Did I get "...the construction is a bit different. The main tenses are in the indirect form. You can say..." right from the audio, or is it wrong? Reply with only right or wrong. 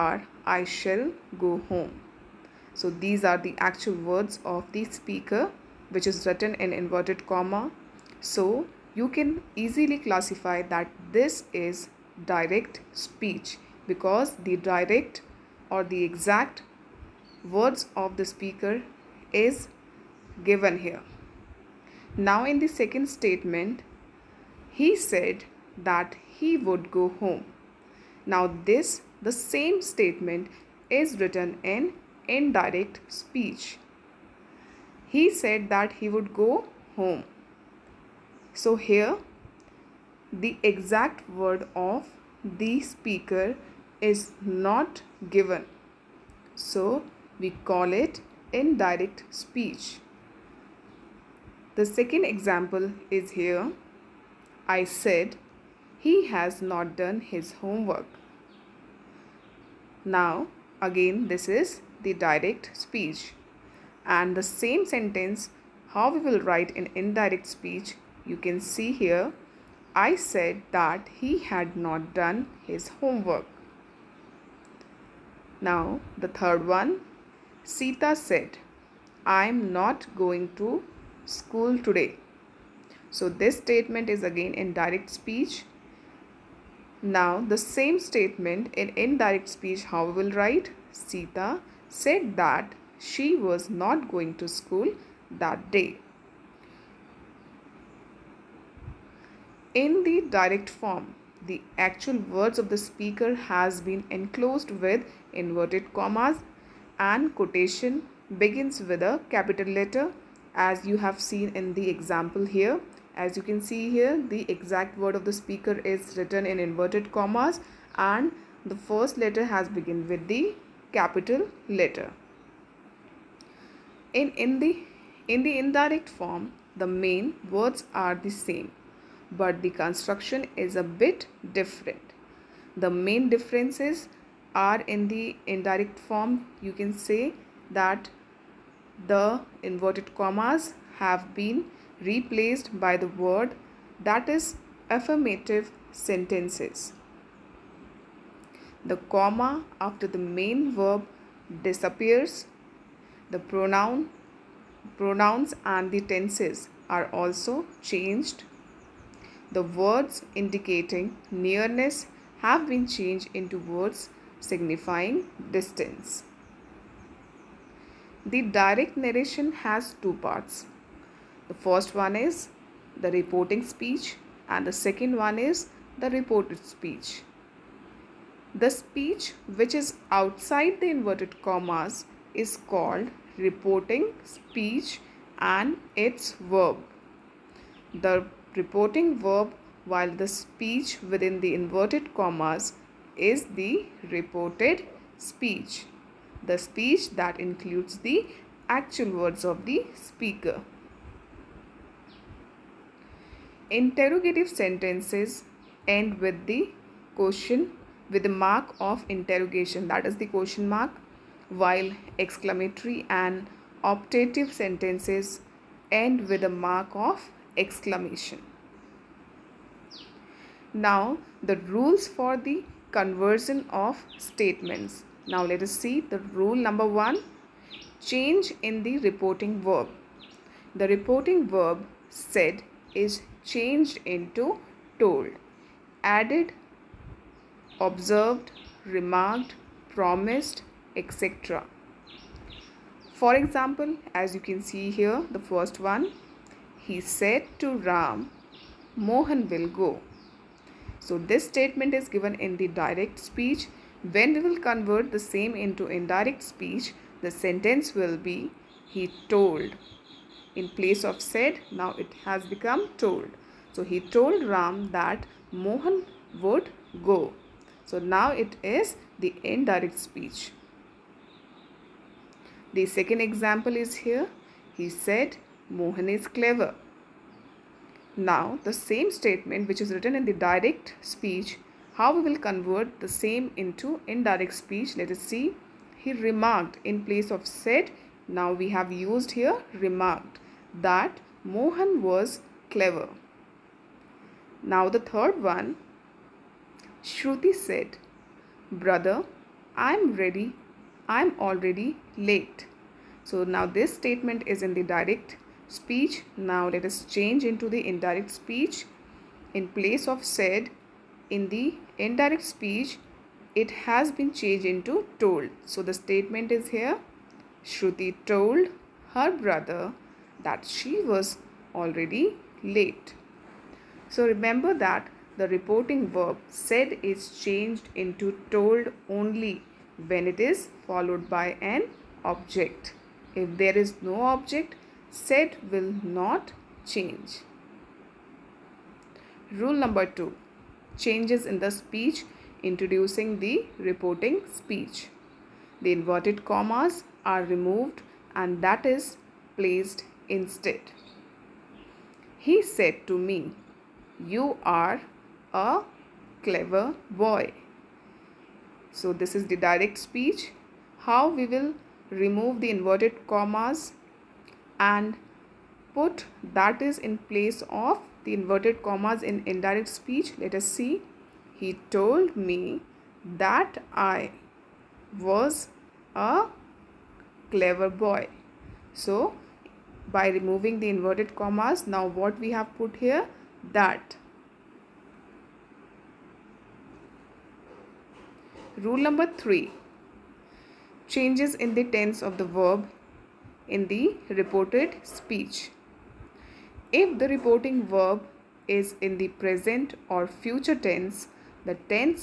wrong.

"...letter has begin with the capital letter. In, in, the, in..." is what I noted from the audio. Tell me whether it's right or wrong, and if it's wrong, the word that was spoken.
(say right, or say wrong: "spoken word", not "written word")
right.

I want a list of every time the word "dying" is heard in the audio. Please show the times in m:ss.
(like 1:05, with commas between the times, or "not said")
not said.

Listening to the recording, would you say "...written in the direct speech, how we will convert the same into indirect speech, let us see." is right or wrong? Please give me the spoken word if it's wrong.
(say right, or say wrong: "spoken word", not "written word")
right.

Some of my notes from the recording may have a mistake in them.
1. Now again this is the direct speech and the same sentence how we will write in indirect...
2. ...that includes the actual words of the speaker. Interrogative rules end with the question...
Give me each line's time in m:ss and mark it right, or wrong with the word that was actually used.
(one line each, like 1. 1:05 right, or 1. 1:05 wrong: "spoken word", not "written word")
1. 1:00 right
2. 3:17 wrong: "sentences", not "rules".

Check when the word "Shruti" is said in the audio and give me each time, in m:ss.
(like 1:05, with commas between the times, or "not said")
4:57, 5:17.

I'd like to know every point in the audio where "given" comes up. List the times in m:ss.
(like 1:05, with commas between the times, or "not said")
0:20, 0:45, 4:12.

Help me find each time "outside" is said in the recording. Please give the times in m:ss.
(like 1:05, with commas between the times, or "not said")
3:00.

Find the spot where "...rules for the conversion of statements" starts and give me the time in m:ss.
3:41.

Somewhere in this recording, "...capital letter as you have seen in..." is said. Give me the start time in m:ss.
1:49.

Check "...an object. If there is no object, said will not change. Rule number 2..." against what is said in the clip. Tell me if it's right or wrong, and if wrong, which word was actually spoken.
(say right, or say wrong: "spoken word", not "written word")
right.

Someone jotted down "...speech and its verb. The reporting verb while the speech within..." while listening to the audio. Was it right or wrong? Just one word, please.
right.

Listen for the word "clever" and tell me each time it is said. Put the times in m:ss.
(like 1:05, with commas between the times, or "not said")
4:36, 4:52, 5:56, 6:17.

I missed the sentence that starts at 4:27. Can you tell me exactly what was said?
So now it is the indirect speech.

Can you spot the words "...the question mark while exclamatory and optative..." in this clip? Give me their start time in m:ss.
3:30.